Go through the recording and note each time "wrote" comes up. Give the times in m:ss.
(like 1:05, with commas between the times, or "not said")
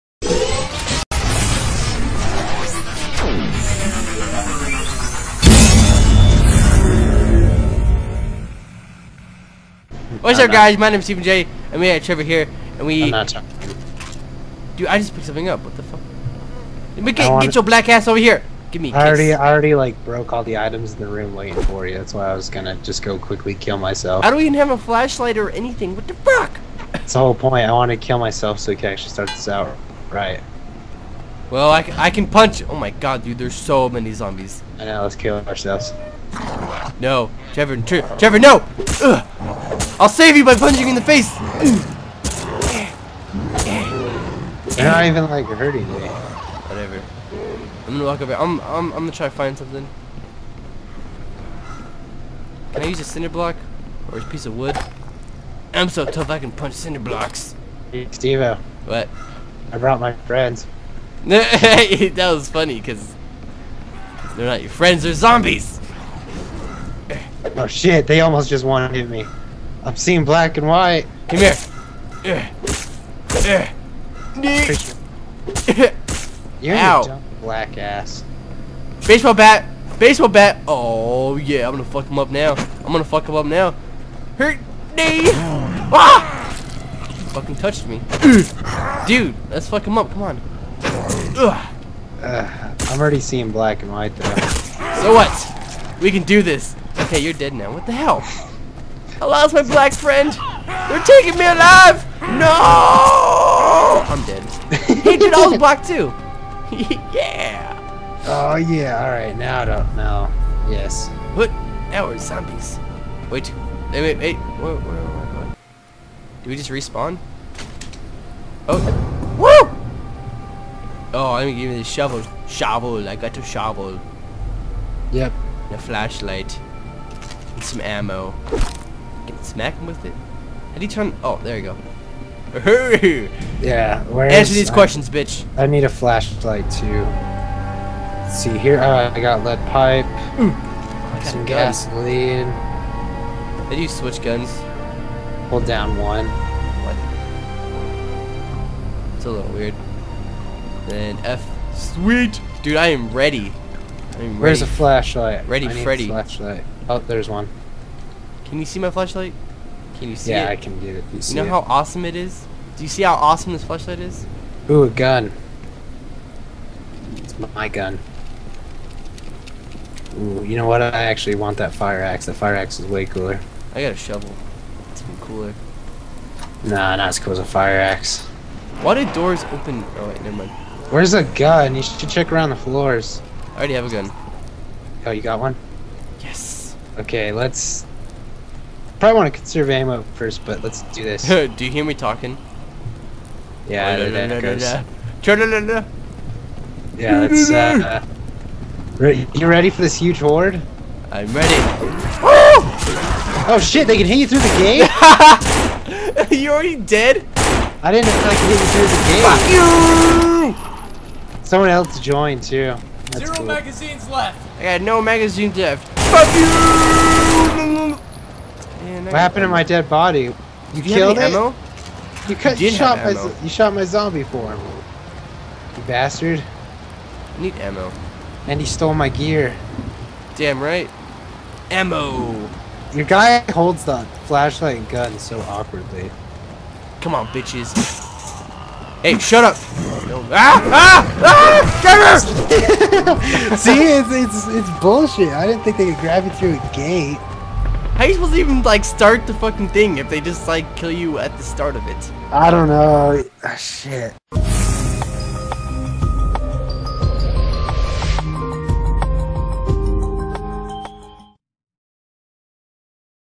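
not said.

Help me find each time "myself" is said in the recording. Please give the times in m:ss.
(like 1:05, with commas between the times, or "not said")
0:23, 0:28.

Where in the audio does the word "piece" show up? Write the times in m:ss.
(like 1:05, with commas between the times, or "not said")
0:54.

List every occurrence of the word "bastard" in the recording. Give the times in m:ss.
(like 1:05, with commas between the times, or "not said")
3:45.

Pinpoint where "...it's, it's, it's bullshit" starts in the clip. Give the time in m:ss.
4:03.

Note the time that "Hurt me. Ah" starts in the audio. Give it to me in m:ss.
1:24.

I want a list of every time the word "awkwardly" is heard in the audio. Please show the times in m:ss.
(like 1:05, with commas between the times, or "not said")
3:55.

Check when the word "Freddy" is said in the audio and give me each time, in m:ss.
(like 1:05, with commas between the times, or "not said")
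2:35.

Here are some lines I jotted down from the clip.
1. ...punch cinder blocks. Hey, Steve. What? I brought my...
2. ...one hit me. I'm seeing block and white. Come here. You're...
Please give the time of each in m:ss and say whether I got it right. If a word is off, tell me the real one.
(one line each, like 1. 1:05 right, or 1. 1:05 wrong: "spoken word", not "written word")
1. 0:56 right
2. 1:08 wrong: "black", not "block".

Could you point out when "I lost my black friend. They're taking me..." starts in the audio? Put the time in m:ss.
1:39.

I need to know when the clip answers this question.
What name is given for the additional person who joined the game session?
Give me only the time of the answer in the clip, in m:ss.
3:33.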